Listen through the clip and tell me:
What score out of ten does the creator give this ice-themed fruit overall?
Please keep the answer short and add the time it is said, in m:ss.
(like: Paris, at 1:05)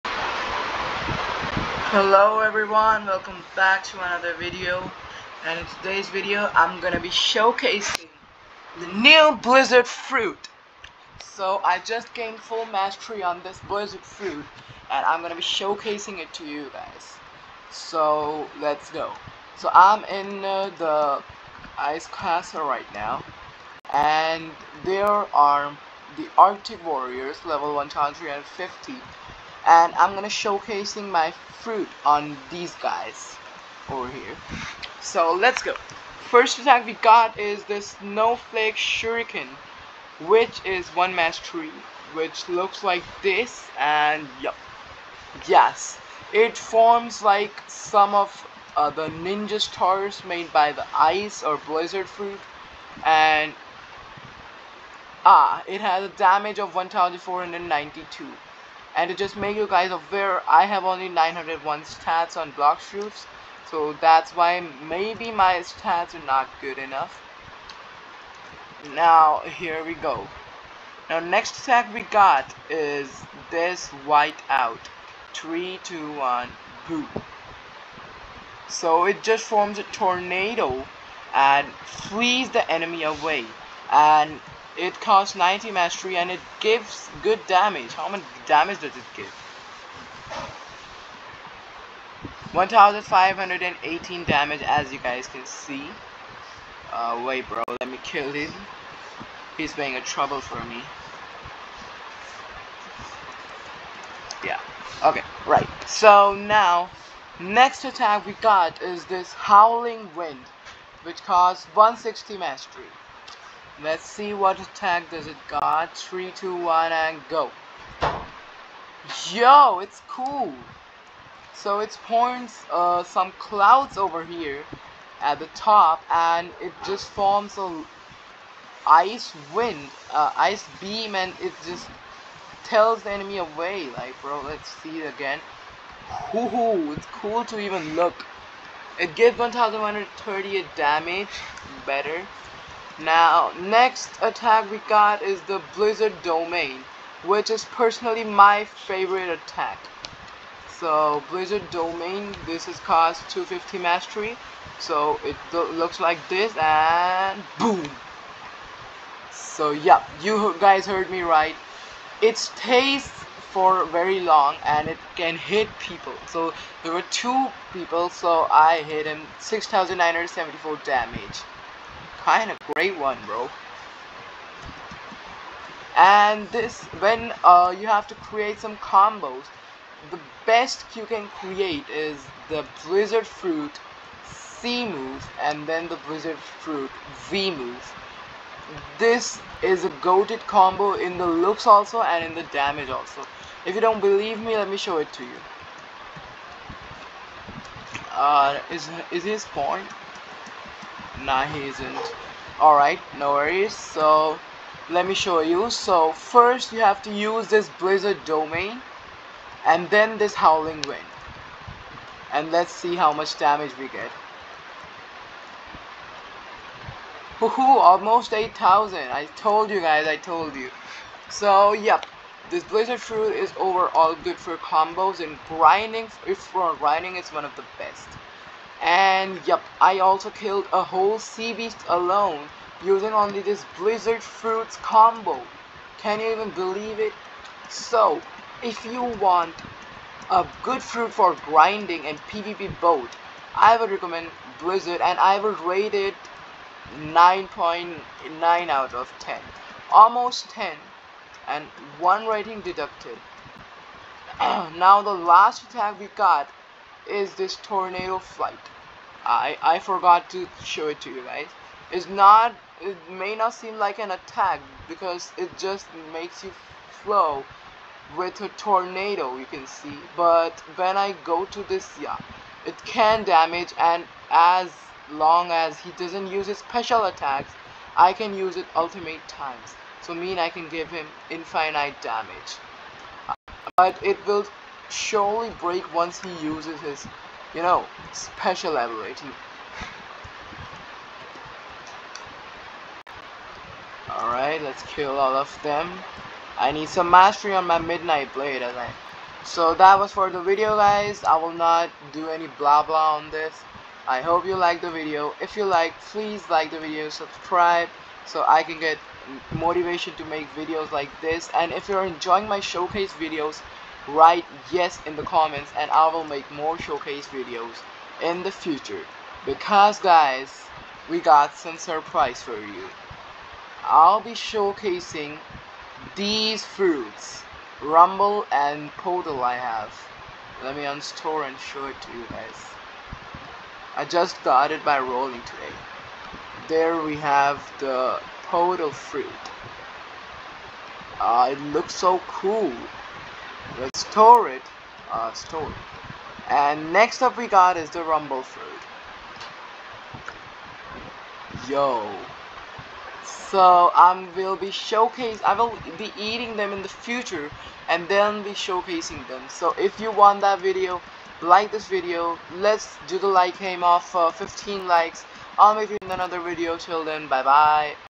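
9.9, at 4:07.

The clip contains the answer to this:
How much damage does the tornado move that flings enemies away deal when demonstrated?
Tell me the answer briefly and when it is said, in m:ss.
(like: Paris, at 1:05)
1518, at 1:32.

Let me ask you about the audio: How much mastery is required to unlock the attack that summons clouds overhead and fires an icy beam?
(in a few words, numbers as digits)
160.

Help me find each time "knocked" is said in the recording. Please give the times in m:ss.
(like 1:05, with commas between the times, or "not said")
not said.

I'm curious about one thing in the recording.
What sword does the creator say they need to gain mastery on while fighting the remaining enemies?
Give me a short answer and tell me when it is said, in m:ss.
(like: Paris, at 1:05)
Midnight Blade, at 4:57.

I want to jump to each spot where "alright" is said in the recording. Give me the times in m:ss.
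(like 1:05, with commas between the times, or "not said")
3:22, 4:54.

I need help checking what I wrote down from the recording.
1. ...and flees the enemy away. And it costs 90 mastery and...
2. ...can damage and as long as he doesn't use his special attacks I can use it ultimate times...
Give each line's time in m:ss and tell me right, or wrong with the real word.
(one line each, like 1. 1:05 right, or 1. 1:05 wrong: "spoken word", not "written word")
1. 1:21 right
2. 4:32 right.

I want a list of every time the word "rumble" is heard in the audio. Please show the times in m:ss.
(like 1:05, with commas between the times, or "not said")
5:27, 5:48.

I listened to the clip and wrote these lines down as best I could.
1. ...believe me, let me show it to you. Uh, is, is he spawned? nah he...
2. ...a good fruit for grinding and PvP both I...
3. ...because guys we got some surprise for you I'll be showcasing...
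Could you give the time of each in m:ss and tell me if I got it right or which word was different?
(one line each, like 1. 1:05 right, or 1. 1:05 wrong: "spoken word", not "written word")
1. 3:13 right
2. 4:00 right
3. 5:19 right.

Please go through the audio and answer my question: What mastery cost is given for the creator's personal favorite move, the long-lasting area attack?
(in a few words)
250.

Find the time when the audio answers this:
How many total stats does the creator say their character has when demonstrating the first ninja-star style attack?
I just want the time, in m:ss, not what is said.
1:01.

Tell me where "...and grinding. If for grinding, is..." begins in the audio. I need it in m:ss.
3:45.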